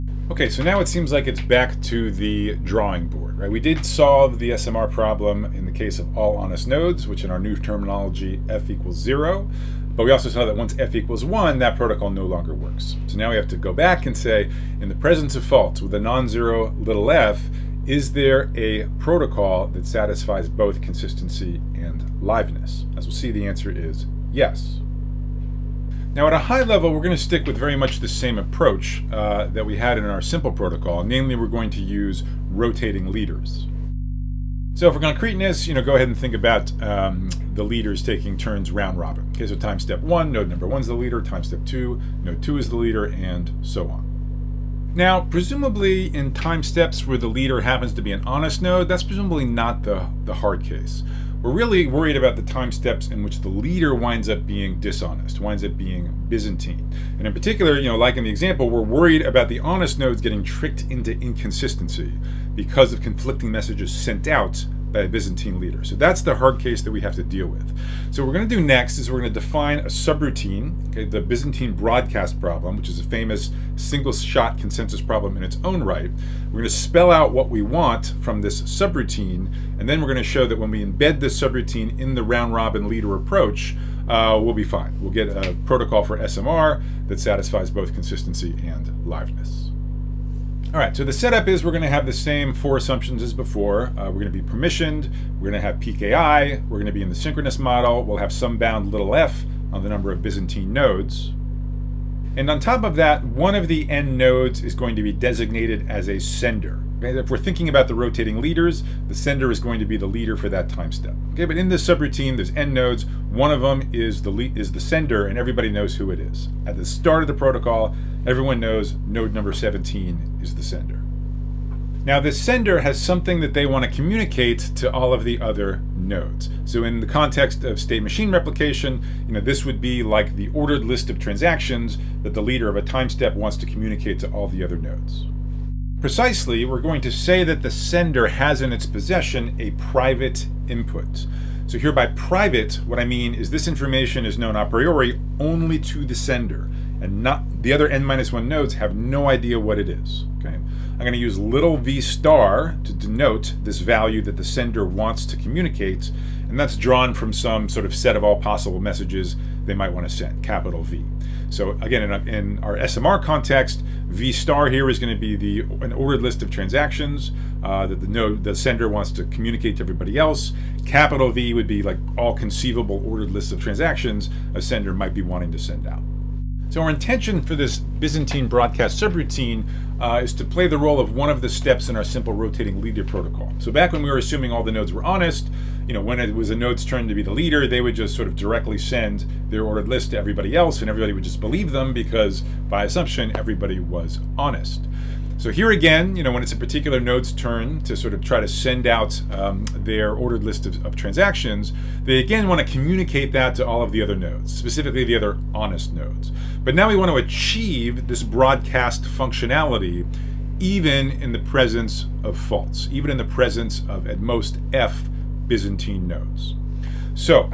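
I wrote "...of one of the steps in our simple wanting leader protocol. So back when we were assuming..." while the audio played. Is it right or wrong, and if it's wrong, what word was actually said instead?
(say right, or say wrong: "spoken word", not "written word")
wrong: "rotating", not "wanting".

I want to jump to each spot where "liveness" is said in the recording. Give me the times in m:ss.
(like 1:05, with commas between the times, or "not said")
0:22, 1:29.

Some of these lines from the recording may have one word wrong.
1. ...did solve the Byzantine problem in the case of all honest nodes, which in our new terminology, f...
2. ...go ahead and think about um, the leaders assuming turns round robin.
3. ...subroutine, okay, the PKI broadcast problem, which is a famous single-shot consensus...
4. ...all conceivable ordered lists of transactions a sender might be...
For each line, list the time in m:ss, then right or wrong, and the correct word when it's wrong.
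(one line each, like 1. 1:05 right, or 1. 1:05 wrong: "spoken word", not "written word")
1. 0:03 wrong: "SMR", not "Byzantine"
2. 0:35 wrong: "taking", not "assuming"
3. 1:09 wrong: "Byzantine", not "PKI"
4. 2:52 right.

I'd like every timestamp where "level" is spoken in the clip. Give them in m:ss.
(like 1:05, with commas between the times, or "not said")
0:26.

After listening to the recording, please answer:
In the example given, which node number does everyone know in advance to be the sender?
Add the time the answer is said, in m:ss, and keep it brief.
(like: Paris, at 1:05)
17, at 1:59.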